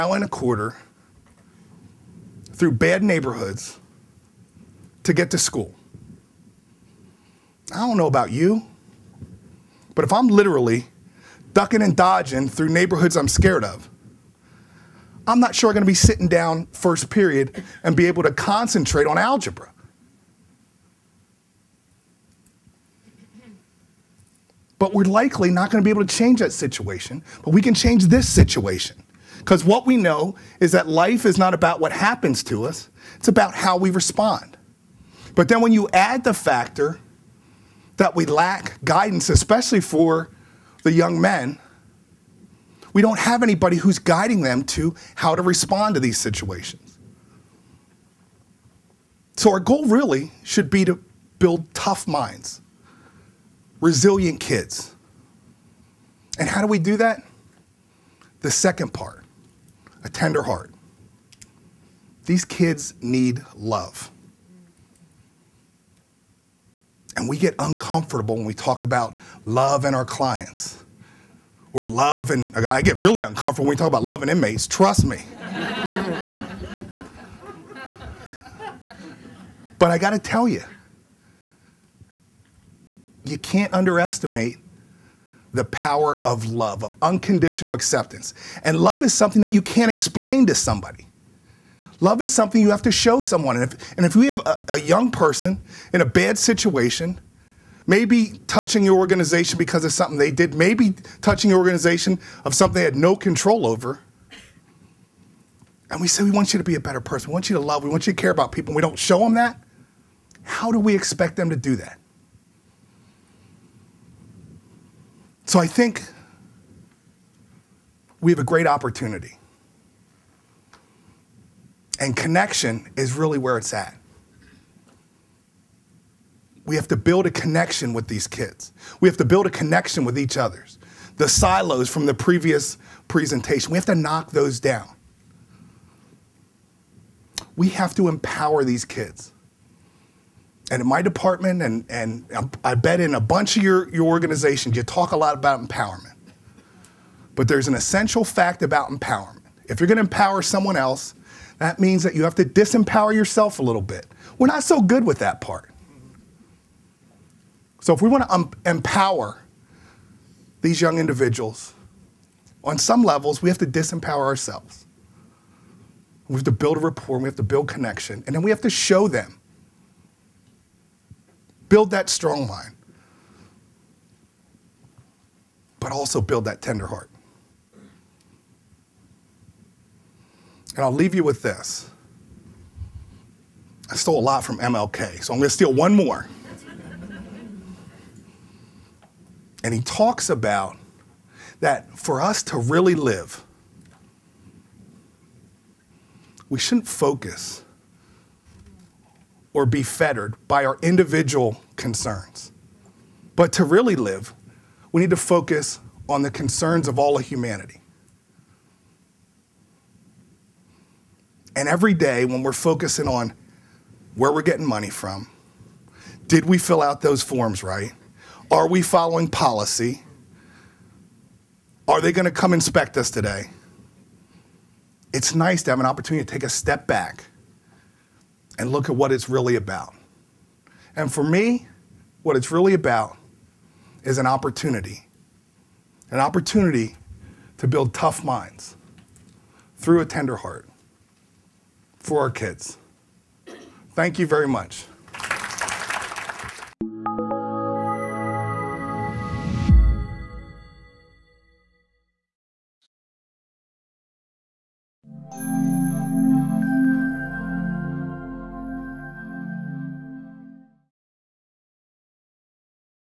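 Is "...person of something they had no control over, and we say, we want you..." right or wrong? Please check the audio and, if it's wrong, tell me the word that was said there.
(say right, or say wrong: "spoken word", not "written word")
wrong: "organization", not "person".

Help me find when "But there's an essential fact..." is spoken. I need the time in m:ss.
2:27.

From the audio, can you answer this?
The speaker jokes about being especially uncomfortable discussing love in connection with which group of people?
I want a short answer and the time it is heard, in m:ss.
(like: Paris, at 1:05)
inmates, at 1:14.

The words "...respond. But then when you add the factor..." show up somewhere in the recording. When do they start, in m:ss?
0:33.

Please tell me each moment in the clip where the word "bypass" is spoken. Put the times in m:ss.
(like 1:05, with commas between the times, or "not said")
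not said.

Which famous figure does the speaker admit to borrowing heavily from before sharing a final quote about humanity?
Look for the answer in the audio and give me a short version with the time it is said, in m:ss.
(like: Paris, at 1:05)
MLK, at 3:04.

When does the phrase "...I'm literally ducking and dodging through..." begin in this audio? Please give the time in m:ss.
0:10.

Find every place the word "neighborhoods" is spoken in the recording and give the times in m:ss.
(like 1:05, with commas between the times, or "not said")
0:03, 0:12.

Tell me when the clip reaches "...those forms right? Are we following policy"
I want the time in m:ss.
3:37.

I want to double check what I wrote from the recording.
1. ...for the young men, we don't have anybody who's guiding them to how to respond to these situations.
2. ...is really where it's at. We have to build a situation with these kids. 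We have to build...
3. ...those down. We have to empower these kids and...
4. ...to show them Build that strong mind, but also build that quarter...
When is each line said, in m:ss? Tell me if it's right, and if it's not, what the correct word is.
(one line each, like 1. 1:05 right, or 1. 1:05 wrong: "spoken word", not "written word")
1. 0:39 right
2. 2:02 wrong: "connection", not "situation"
3. 2:14 right
4. 2:48 wrong: "tender", not "quarter".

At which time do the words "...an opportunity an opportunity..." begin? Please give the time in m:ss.
3:54.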